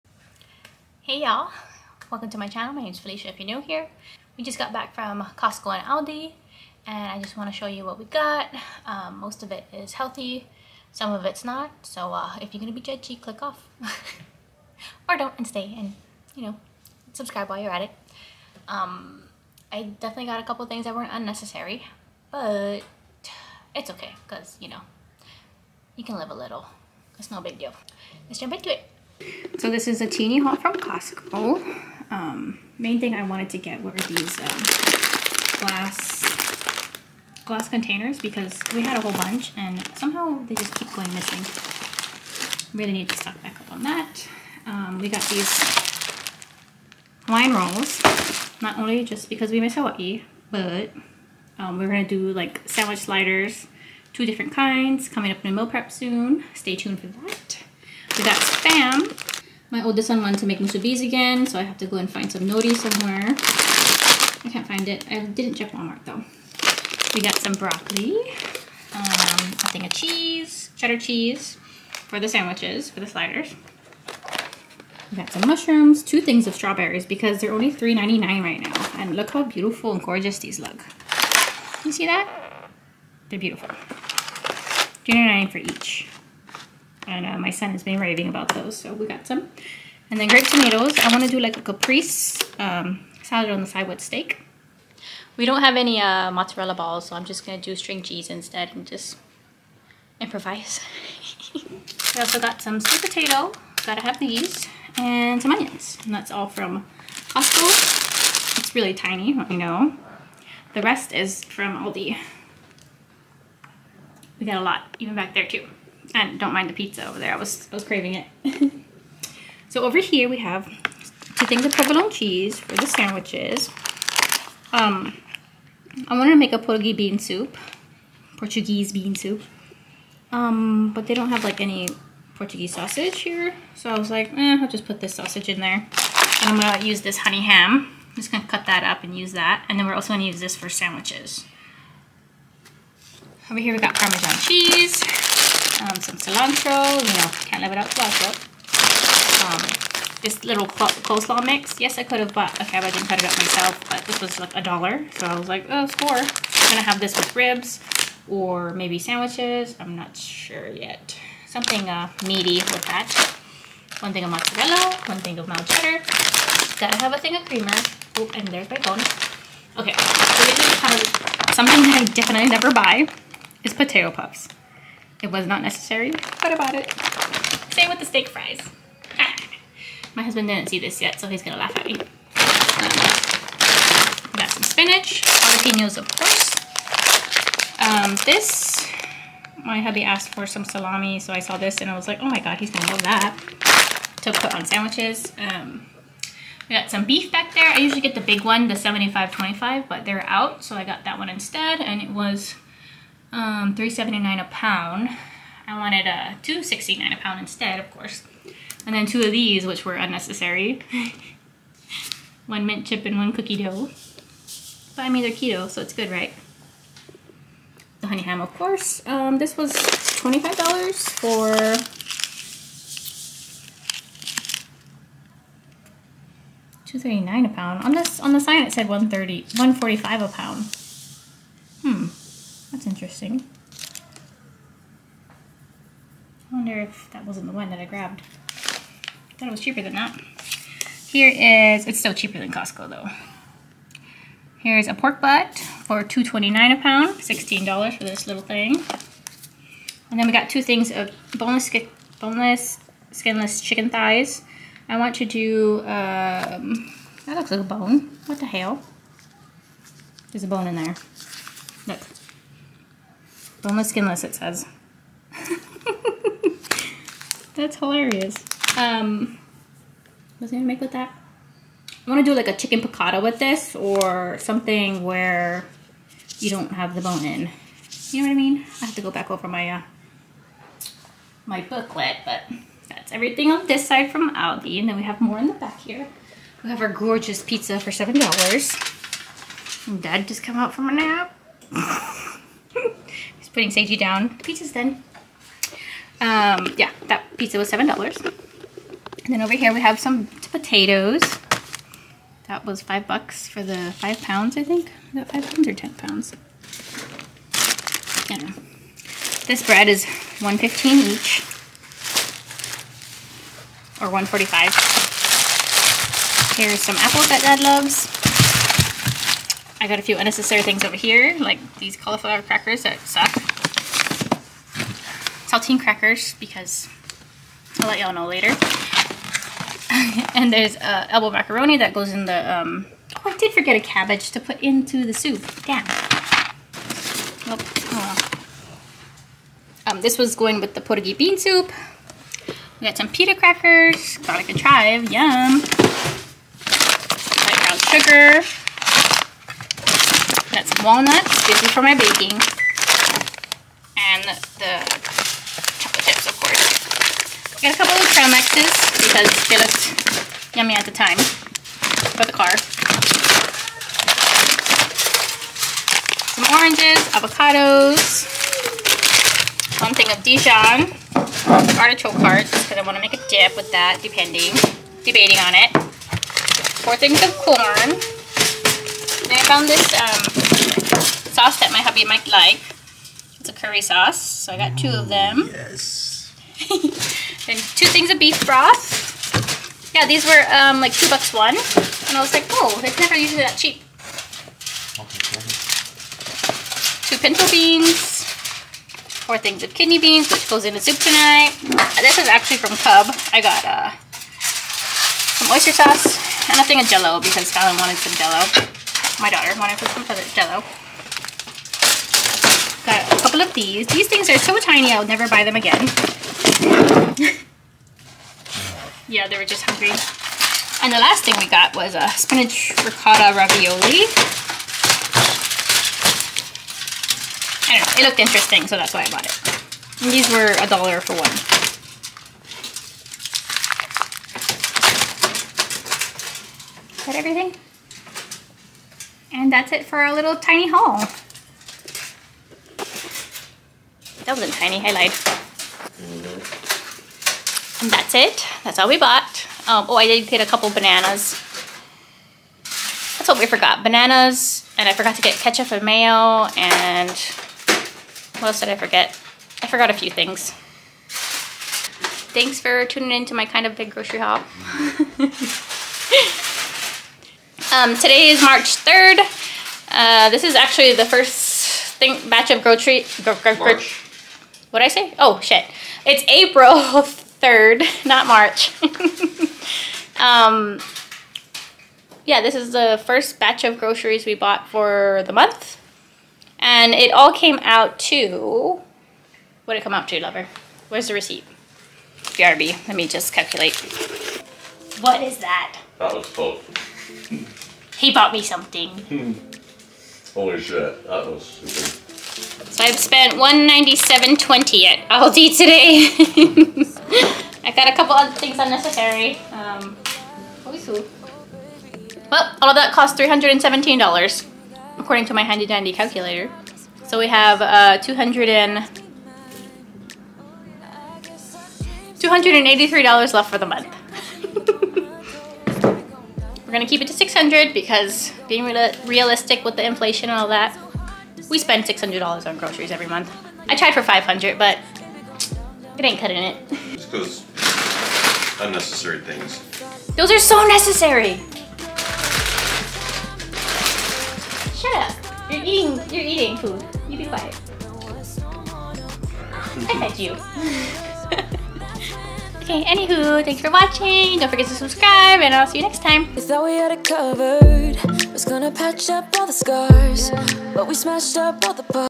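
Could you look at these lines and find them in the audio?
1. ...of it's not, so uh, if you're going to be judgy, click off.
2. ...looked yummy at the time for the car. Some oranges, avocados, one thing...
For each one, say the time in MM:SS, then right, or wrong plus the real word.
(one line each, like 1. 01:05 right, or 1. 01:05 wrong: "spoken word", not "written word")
1. 00:11 right
2. 05:59 right.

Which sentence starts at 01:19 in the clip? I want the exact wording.
And look how beautiful and gorgeous these look.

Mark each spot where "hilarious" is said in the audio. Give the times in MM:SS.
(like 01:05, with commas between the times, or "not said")
04:27.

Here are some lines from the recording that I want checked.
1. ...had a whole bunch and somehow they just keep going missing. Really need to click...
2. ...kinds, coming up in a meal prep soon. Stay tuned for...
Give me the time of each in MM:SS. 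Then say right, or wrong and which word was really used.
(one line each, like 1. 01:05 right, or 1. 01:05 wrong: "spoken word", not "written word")
1. 00:38 wrong: "stock", not "click"
2. 00:54 right.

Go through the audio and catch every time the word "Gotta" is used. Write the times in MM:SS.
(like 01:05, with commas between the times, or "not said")
01:43, 02:46.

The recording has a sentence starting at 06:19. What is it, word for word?
Then I found this um, sauce that my hubby might like.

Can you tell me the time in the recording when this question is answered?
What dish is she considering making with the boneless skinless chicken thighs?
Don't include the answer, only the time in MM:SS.
04:32.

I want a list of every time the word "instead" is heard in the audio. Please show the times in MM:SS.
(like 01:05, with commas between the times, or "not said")
01:38, 03:21, 03:27.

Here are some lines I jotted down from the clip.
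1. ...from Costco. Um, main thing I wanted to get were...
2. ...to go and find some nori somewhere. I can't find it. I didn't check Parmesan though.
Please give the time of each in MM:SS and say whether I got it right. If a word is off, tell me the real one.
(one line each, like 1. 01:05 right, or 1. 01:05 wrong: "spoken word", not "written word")
1. 00:30 right
2. 01:01 wrong: "Walmart", not "Parmesan".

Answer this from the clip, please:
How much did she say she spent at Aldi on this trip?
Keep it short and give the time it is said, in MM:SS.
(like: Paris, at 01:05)
$197.20, at 08:23.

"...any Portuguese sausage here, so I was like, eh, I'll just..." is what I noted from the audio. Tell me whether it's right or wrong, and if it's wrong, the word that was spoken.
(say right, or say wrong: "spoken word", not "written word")
right.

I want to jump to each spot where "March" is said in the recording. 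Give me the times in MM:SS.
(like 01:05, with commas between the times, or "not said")
07:48, 07:53, 07:58.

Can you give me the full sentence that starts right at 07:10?
And these were a dollar for one.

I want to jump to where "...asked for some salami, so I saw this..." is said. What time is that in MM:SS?
03:10.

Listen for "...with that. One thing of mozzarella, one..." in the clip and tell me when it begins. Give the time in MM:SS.
02:42.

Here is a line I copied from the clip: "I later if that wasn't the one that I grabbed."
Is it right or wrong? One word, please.
wrong.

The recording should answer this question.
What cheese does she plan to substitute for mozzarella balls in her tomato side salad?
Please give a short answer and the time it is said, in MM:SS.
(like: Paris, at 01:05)
String cheese, at 01:37.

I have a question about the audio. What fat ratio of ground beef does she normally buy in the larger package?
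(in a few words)
75-25.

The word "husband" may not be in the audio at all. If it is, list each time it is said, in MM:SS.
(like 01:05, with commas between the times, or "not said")
03:00.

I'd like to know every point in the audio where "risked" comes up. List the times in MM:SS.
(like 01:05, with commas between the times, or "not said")
not said.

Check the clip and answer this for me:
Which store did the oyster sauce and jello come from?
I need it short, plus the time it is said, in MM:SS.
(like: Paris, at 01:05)
Cub, at 06:42.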